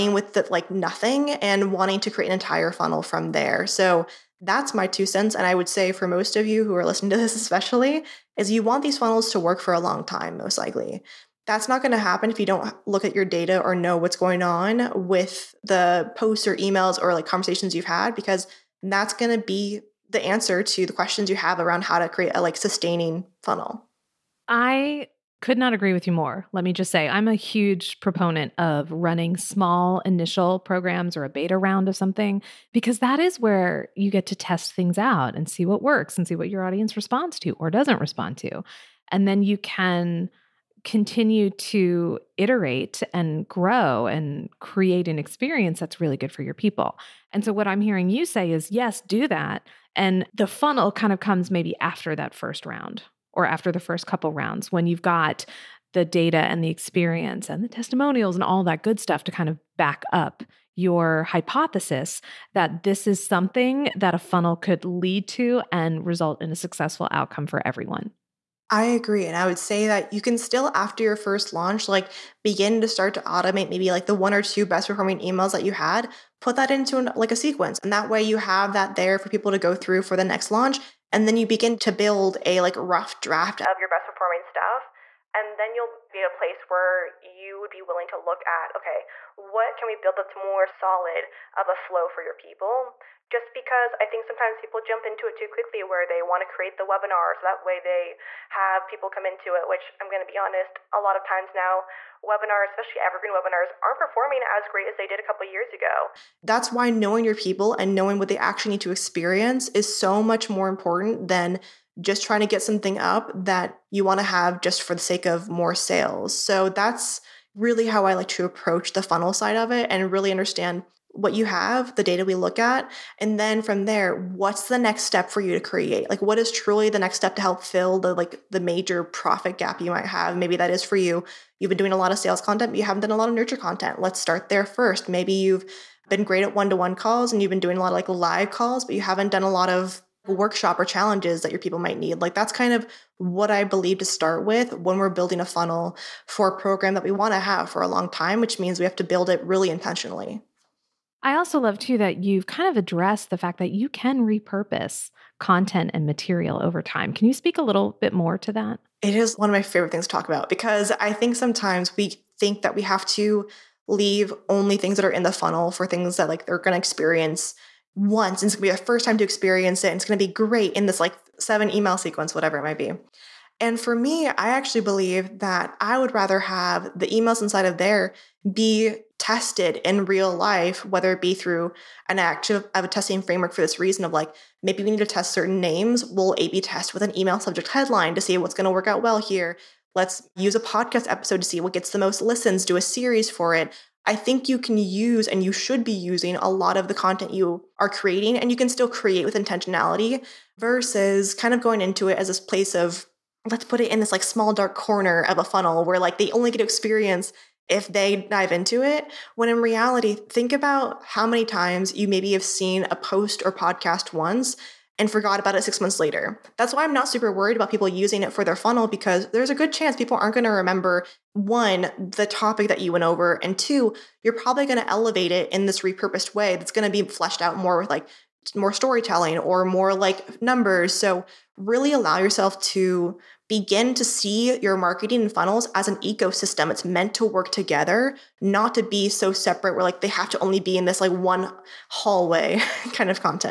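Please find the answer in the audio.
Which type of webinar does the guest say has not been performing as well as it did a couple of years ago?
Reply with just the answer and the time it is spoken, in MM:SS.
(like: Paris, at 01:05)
evergreen webinars, at 01:43.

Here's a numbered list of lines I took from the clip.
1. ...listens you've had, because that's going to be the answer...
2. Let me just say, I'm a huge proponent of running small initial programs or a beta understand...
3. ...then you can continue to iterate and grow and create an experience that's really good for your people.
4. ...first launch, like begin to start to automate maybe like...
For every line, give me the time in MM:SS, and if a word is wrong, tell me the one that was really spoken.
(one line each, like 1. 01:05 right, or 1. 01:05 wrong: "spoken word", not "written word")
1. 00:17 wrong: "conversations", not "listens"
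2. 00:26 wrong: "round", not "understand"
3. 00:39 right
4. 01:11 right.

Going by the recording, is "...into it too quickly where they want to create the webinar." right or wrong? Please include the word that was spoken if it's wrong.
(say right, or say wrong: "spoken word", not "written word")
right.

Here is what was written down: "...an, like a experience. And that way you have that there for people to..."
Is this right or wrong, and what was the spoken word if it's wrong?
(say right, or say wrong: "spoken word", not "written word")
wrong: "sequence", not "experience".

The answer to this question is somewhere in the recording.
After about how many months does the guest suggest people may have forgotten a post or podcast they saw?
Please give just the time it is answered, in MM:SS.
03:35.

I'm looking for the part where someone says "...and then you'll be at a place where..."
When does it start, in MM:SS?
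01:25.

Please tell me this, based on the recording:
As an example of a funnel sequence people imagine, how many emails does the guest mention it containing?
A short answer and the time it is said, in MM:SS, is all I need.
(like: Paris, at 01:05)
7, at 02:51.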